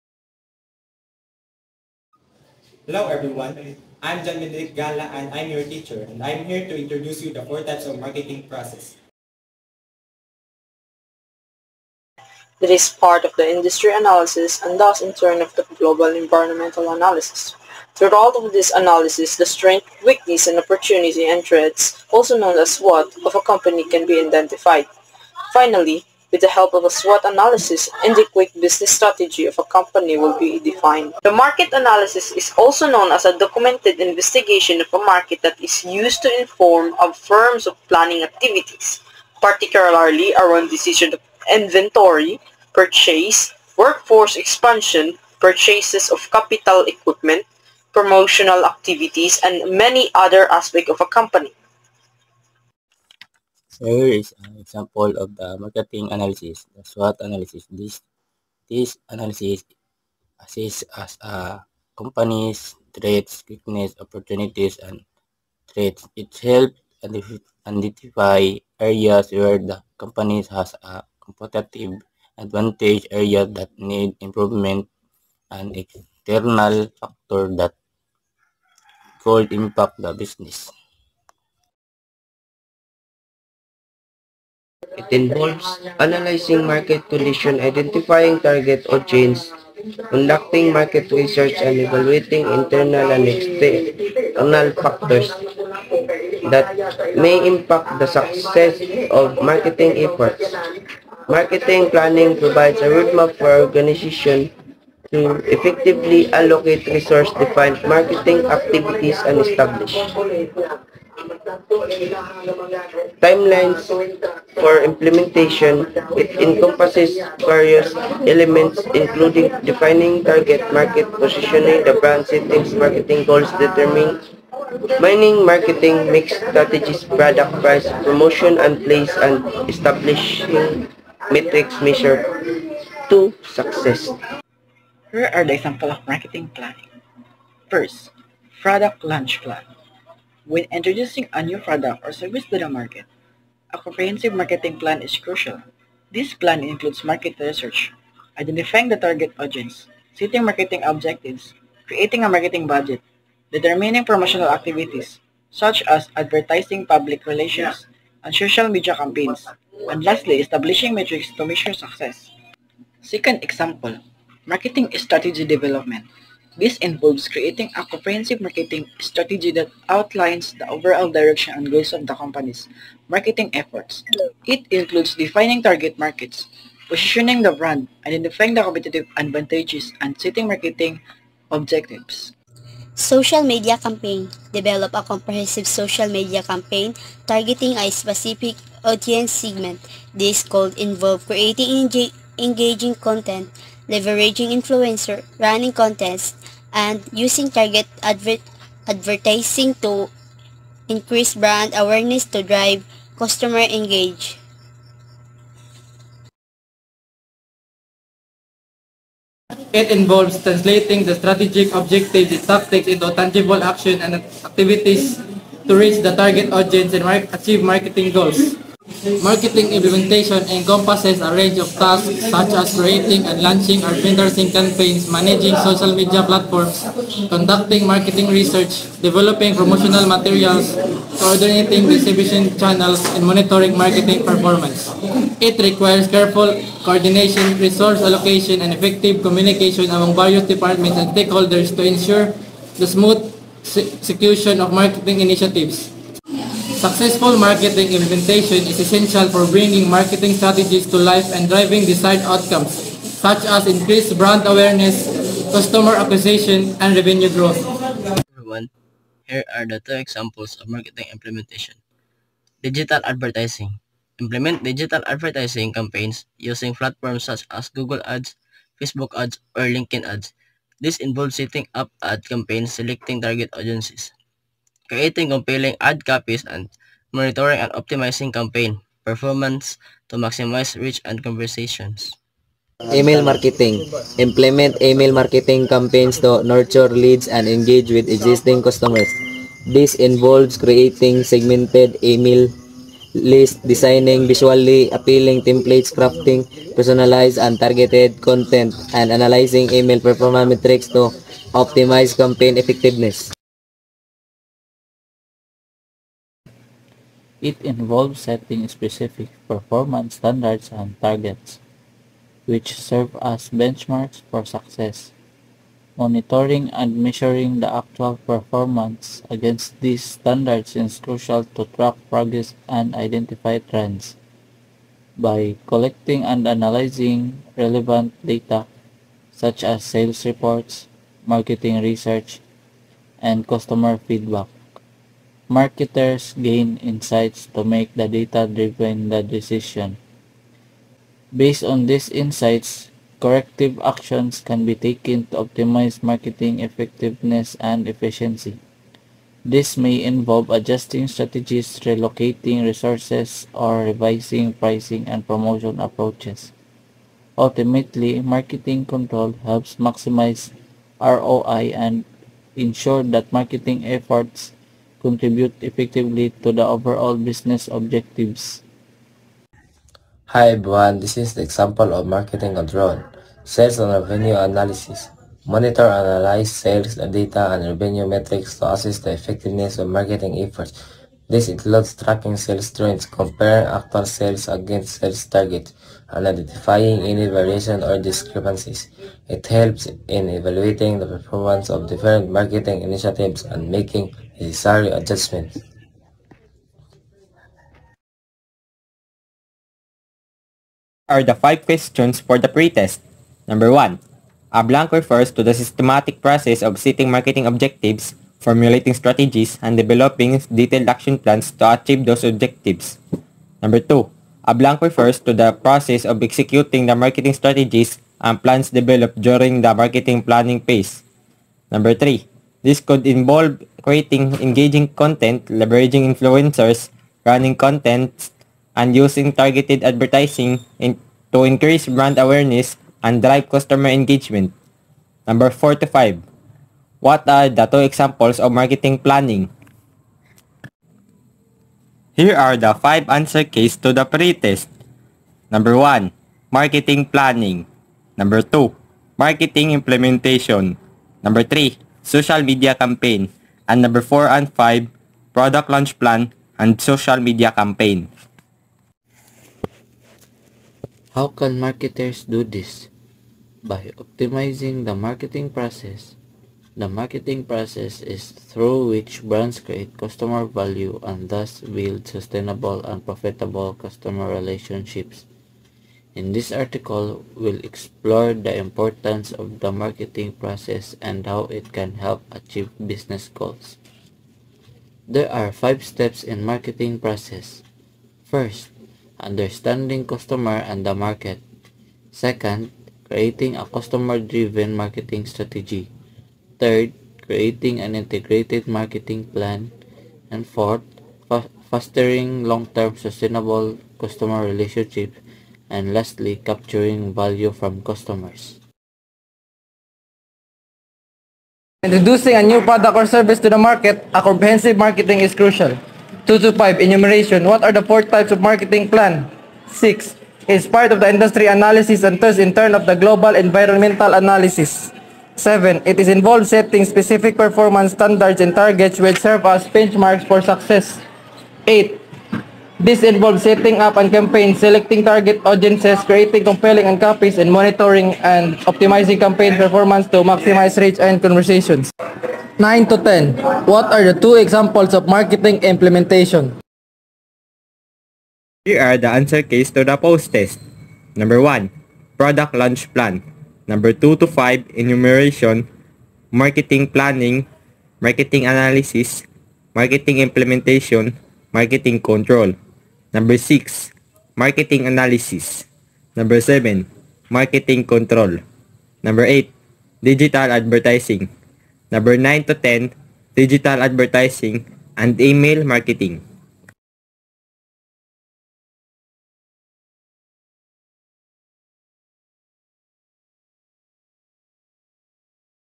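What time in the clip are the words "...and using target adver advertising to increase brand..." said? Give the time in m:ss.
3:16.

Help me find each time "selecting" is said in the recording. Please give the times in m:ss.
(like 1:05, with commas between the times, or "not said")
4:32, 8:54.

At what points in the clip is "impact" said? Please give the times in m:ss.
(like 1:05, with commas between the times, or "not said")
1:19, 1:37.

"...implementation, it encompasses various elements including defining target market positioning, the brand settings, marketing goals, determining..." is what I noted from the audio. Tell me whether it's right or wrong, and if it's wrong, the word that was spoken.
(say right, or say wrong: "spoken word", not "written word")
right.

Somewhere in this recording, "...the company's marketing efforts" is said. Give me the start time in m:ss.
2:52.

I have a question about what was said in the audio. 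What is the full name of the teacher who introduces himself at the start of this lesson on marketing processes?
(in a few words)
John Medric Gala.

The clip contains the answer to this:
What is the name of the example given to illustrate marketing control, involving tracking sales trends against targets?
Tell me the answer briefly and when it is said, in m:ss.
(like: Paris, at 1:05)
Sales and revenue analysis, at 6:13.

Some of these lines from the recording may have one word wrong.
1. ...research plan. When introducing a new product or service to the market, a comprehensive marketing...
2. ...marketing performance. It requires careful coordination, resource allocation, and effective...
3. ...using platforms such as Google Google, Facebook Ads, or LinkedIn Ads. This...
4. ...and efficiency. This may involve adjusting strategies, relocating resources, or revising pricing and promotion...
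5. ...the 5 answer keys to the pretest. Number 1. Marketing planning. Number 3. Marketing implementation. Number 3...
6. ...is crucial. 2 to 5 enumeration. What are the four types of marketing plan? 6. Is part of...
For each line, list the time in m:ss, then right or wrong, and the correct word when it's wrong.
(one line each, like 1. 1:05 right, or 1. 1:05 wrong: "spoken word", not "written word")
1. 2:19 wrong: "launch", not "research"
2. 3:53 right
3. 4:26 wrong: "Ads", not "Google"
4. 5:47 right
5. 7:22 wrong: "2", not "3"
6. 8:35 right.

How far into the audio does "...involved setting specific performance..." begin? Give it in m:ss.
8:46.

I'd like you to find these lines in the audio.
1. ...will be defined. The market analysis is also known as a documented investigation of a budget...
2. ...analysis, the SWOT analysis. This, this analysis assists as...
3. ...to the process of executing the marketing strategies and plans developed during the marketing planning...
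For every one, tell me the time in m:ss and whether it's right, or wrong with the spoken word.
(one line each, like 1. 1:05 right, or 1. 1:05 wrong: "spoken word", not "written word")
1. 0:30 wrong: "market", not "budget"
2. 0:56 right
3. 6:55 right.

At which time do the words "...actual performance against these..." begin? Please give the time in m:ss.
5:17.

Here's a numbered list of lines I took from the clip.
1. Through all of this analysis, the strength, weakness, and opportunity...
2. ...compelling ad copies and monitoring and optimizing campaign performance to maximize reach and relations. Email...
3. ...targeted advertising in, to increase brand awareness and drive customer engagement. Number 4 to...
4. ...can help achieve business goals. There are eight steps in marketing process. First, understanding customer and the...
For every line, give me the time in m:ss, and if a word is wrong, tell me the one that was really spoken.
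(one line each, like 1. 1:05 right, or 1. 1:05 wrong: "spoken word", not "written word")
1. 0:17 right
2. 4:35 wrong: "conversations", not "relations"
3. 7:09 right
4. 8:01 wrong: "five", not "eight".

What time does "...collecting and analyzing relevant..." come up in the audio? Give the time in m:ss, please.
5:25.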